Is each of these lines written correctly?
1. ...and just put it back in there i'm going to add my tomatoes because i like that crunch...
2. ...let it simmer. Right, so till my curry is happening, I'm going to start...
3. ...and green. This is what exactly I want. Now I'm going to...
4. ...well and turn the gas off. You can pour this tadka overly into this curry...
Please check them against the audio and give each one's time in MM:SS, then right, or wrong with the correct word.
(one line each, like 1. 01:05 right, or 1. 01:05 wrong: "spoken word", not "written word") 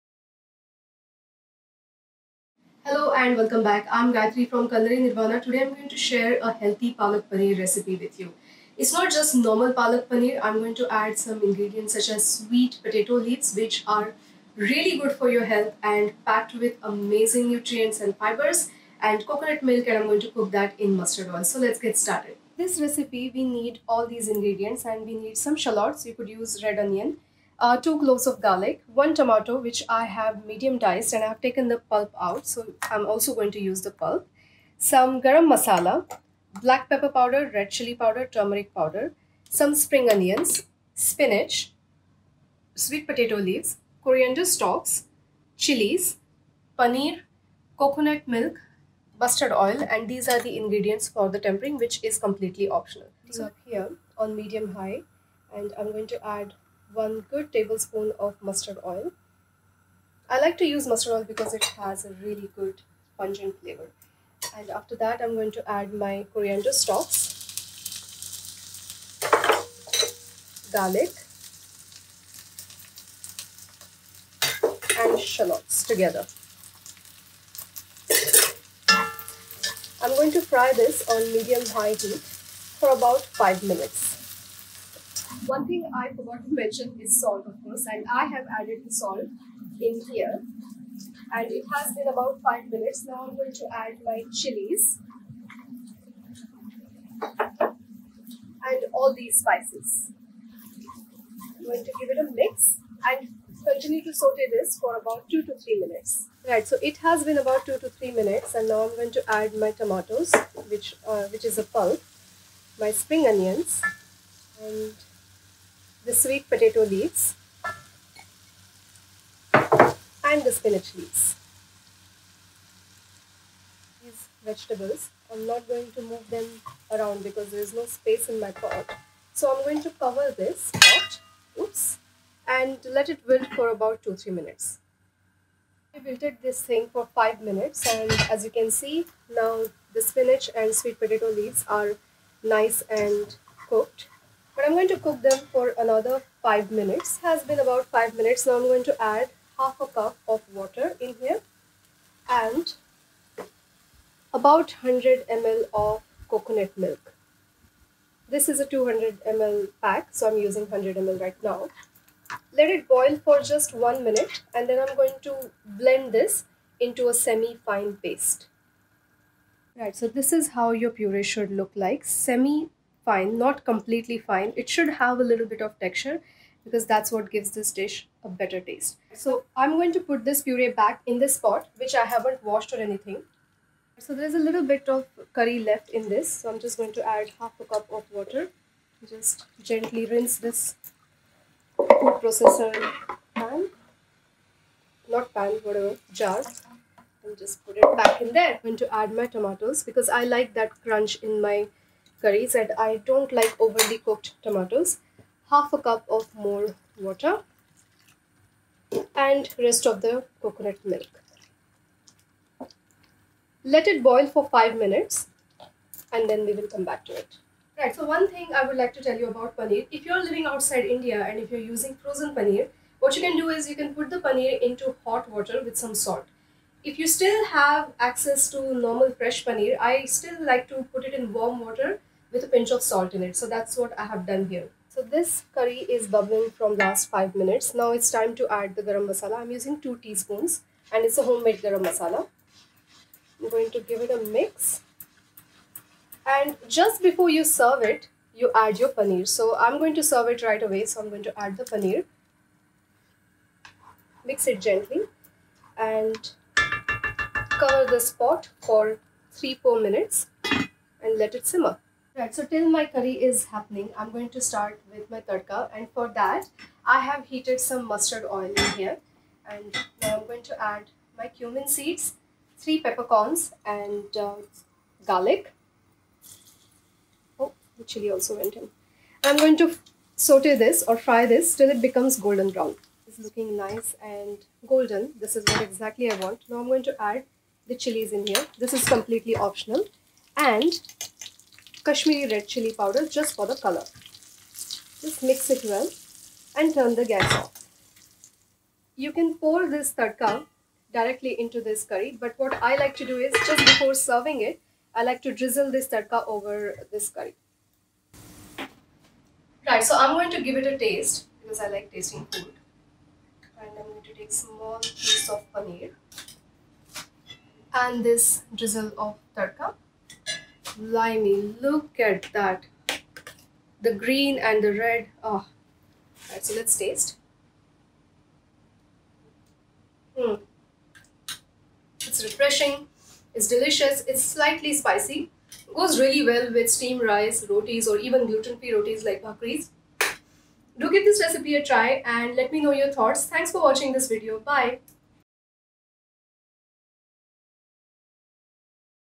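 1. 03:17 right
2. 04:21 right
3. 04:44 wrong: "golden", not "green"
4. 04:55 wrong: "directly", not "overly".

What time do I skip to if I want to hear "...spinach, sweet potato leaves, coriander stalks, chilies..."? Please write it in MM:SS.
00:40.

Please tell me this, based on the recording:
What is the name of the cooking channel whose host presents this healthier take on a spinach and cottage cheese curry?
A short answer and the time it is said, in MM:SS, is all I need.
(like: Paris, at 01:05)
Culinary Nirvana, at 00:04.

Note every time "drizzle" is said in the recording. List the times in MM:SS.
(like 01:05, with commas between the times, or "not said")
05:05, 05:18.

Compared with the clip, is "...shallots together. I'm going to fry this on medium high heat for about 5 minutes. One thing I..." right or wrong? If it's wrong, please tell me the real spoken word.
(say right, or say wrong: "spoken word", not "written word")
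right.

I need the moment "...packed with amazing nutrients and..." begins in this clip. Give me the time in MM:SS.
00:16.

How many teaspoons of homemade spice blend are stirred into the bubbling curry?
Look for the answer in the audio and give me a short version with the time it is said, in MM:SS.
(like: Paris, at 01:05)
2, at 03:59.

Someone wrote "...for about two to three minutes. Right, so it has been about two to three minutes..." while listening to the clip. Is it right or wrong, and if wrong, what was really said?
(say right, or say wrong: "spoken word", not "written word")
right.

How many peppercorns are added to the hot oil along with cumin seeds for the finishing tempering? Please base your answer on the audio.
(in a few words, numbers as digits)
3.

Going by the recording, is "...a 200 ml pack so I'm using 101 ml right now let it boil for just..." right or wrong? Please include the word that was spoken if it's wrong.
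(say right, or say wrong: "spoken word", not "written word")
wrong: "100", not "101".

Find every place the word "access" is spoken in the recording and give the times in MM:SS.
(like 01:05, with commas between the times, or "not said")
03:48.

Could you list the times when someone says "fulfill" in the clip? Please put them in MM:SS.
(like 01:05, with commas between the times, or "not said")
not said.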